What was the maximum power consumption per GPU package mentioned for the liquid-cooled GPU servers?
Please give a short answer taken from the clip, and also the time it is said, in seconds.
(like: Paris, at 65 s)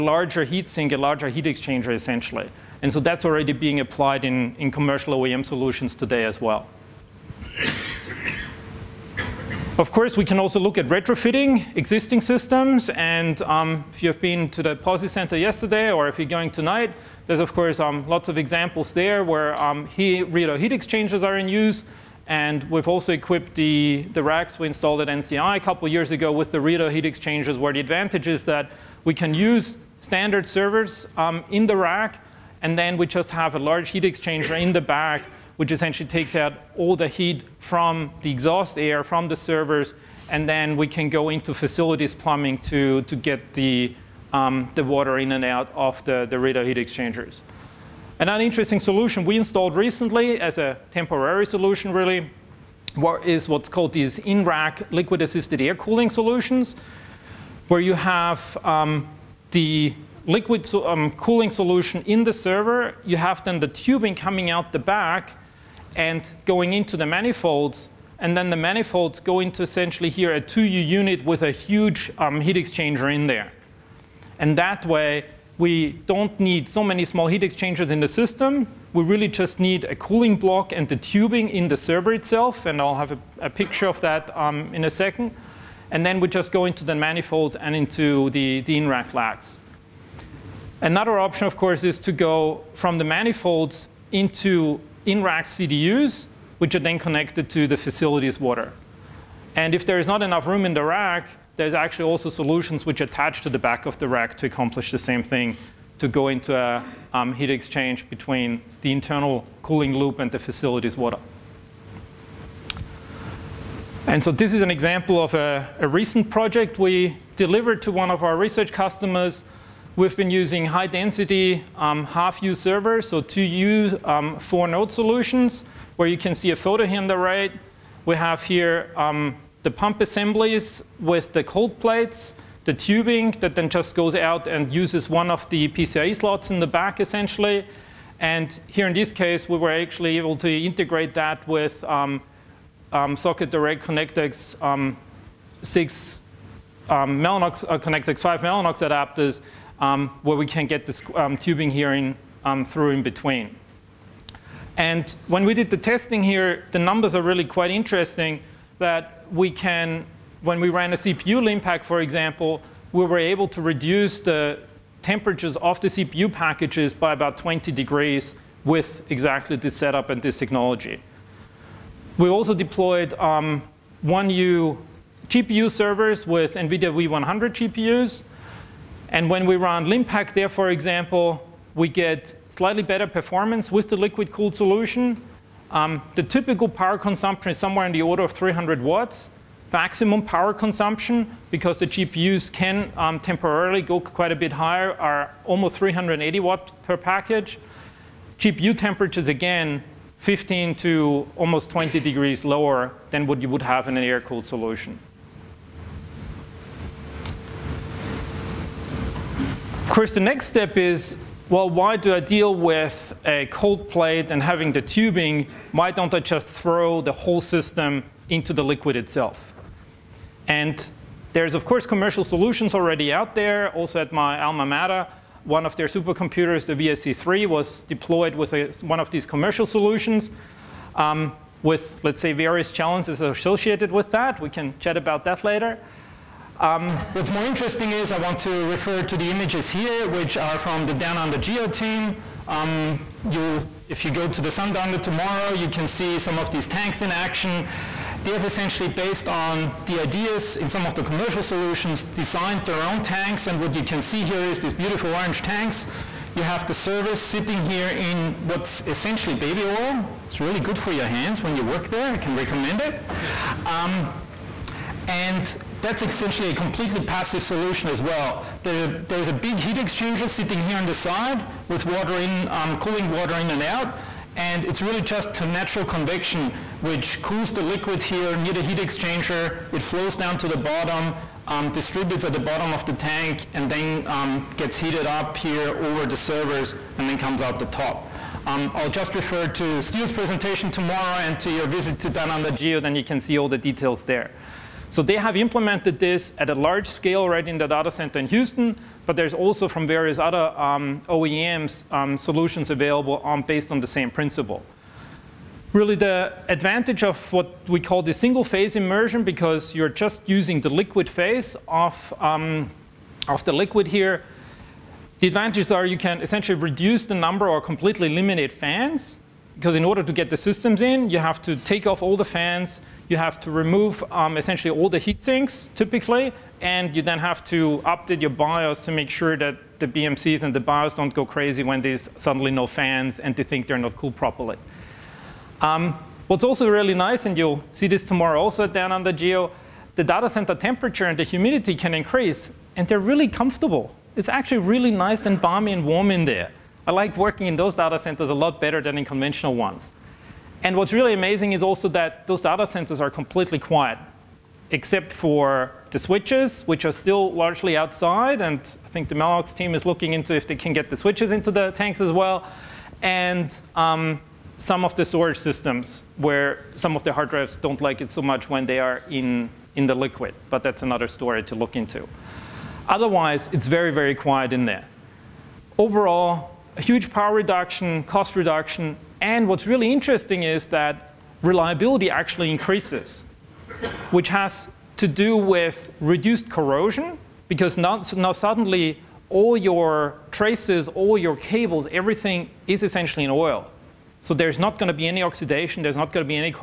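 380 watts, at 195 s.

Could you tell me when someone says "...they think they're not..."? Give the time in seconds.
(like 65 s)
333 s.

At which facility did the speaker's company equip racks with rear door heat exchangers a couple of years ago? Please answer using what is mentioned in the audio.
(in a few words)
NCI.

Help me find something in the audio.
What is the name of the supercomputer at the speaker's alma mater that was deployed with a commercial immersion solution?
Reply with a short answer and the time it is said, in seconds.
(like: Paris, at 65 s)
VSC3, at 226 s.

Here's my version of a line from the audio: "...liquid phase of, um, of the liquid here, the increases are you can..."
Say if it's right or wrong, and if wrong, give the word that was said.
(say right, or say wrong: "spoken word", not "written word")
wrong: "advantages", not "increases".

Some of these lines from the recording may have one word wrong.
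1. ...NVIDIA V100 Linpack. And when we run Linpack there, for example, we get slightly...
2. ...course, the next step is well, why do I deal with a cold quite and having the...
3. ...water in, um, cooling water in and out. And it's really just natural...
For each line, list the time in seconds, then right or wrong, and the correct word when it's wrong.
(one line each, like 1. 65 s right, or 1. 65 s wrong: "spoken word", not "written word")
1. 176 s wrong: "GPUs", not "Linpack"
2. 209 s wrong: "plate", not "quite"
3. 271 s right.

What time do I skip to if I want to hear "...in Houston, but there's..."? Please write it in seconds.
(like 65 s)
298 s.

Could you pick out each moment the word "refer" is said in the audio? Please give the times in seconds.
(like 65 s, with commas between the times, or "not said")
238 s, 289 s.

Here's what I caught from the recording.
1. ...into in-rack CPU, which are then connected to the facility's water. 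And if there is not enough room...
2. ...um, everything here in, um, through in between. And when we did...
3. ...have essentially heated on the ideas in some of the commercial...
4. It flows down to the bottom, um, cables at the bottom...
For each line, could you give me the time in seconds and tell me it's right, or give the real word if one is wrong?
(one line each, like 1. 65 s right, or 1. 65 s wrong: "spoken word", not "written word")
1. 94 s wrong: "CDUs", not "CPU"
2. 151 s wrong: "tubing", not "everything"
3. 248 s wrong: "based", not "heated"
4. 279 s wrong: "distributes", not "cables".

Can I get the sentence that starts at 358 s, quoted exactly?
And I think the Mellanox team is looking into if they can get the switches into the tanks as well.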